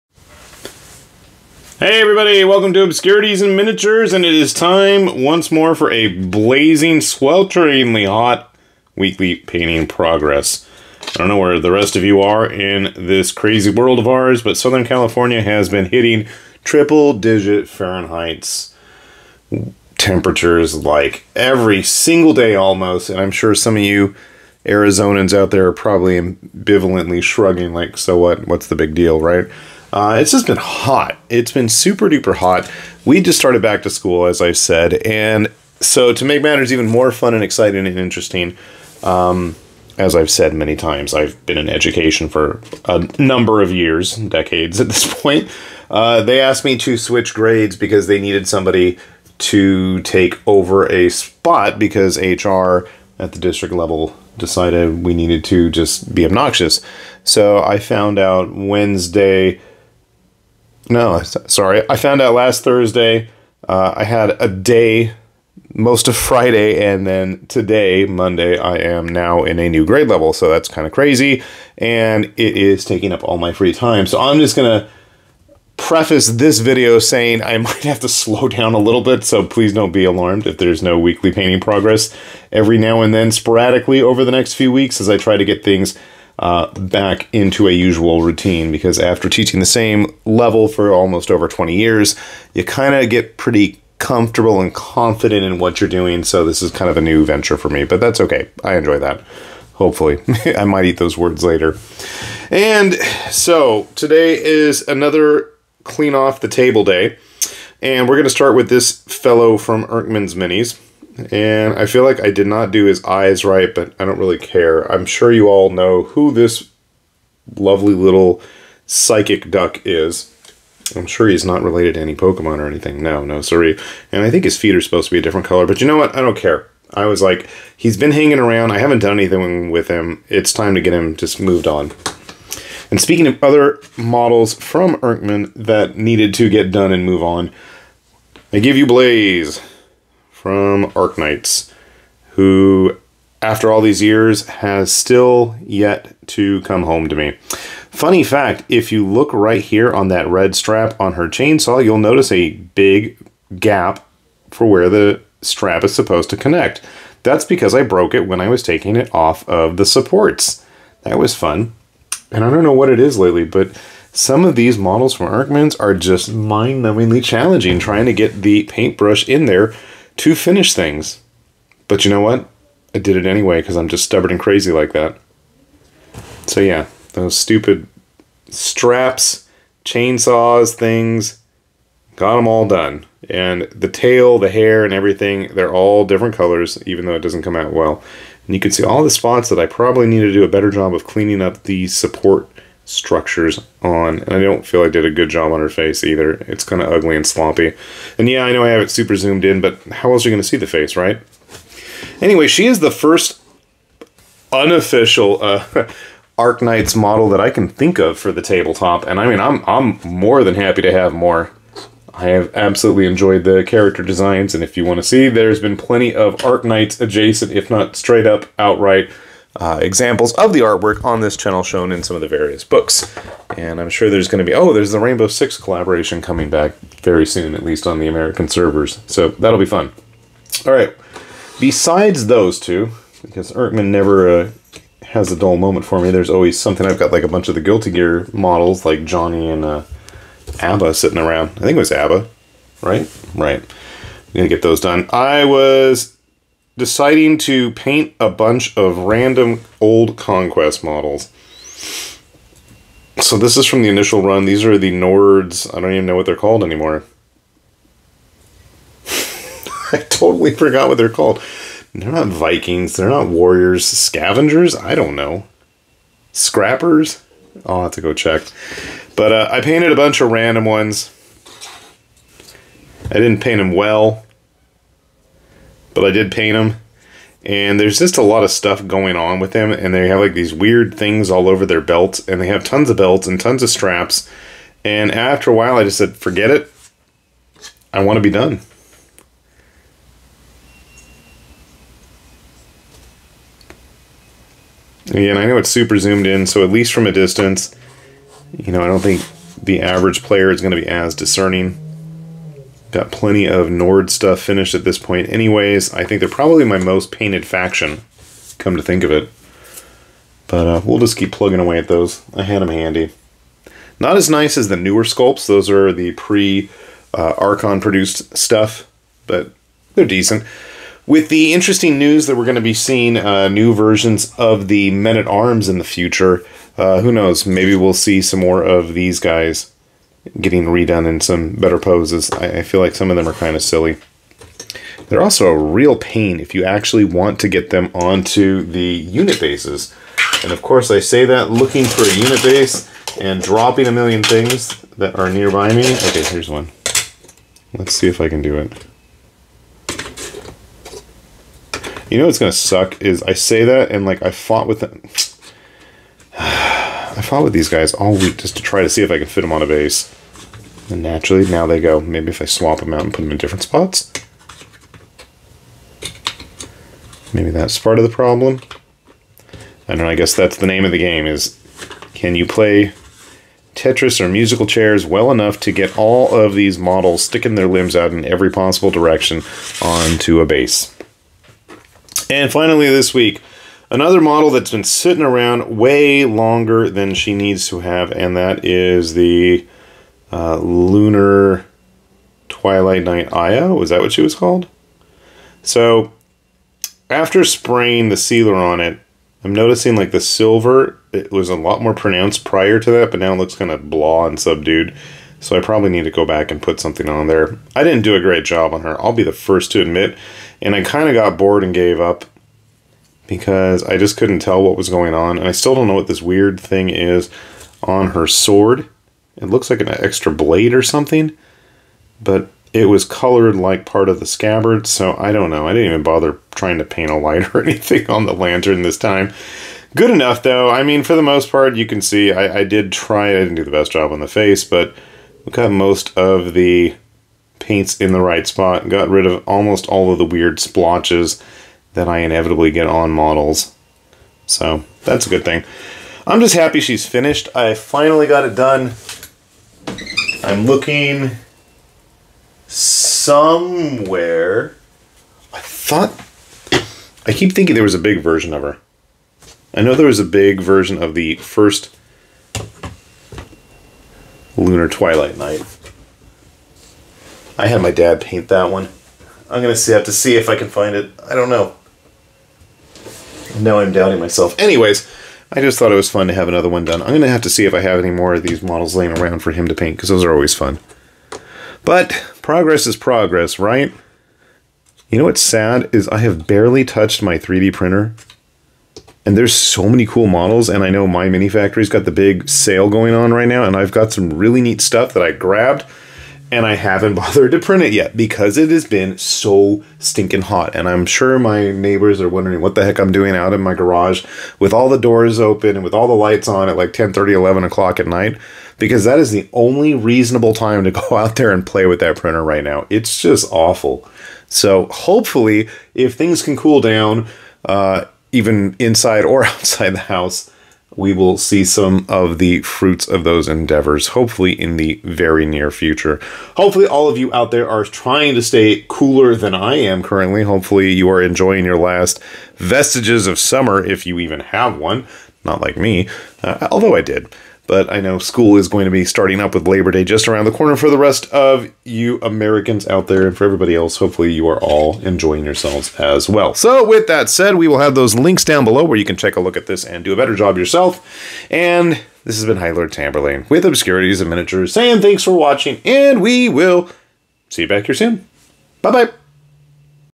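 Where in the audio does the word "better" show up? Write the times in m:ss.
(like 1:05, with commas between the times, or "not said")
3:10, 5:31, 9:10.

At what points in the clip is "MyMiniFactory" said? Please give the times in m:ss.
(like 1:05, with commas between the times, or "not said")
8:11.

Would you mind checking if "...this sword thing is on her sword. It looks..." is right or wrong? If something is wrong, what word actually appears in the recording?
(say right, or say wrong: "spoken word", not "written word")
wrong: "weird", not "sword".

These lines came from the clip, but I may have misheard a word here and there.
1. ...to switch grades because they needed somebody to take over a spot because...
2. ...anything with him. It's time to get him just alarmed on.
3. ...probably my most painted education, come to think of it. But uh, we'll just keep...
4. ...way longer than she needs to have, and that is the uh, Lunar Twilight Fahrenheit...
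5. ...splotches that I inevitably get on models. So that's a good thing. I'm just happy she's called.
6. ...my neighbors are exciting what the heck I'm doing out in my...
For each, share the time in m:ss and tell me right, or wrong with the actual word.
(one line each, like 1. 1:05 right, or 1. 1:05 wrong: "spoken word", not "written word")
1. 0:46 right
2. 2:09 wrong: "moved", not "alarmed"
3. 5:06 wrong: "faction", not "education"
4. 6:25 wrong: "Knight", not "Fahrenheit"
5. 7:20 wrong: "finished", not "called"
6. 8:21 wrong: "wondering", not "exciting".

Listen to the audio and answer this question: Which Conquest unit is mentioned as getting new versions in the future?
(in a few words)
Men-at-Arms.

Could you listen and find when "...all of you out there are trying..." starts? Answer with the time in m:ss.
8:46.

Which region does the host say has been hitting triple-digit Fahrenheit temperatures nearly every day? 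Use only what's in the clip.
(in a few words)
Southern California.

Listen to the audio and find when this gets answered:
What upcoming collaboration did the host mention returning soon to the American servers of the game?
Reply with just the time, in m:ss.
3:44.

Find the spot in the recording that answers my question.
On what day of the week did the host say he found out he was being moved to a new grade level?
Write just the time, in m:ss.
1:02.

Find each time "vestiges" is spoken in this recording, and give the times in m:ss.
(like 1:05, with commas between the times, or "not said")
8:52.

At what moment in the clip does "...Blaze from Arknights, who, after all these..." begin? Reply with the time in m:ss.
2:18.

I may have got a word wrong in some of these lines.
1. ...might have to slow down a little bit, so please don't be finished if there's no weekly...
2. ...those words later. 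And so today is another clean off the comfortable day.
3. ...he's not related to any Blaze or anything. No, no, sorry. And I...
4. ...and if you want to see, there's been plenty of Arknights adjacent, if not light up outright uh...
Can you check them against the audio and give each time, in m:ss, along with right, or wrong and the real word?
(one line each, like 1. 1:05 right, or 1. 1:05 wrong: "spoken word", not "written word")
1. 1:17 wrong: "alarmed", not "finished"
2. 1:40 wrong: "table", not "comfortable"
3. 2:01 wrong: "Pokemon", not "Blaze"
4. 3:34 wrong: "straight", not "light".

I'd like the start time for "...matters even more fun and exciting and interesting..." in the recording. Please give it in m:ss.
0:36.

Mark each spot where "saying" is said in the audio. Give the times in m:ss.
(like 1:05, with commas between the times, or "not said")
1:16, 9:14.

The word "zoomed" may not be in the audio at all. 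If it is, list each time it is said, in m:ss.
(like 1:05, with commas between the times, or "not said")
3:19, 4:55.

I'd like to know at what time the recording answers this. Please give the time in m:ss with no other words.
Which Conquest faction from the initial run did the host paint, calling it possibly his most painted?
4:14.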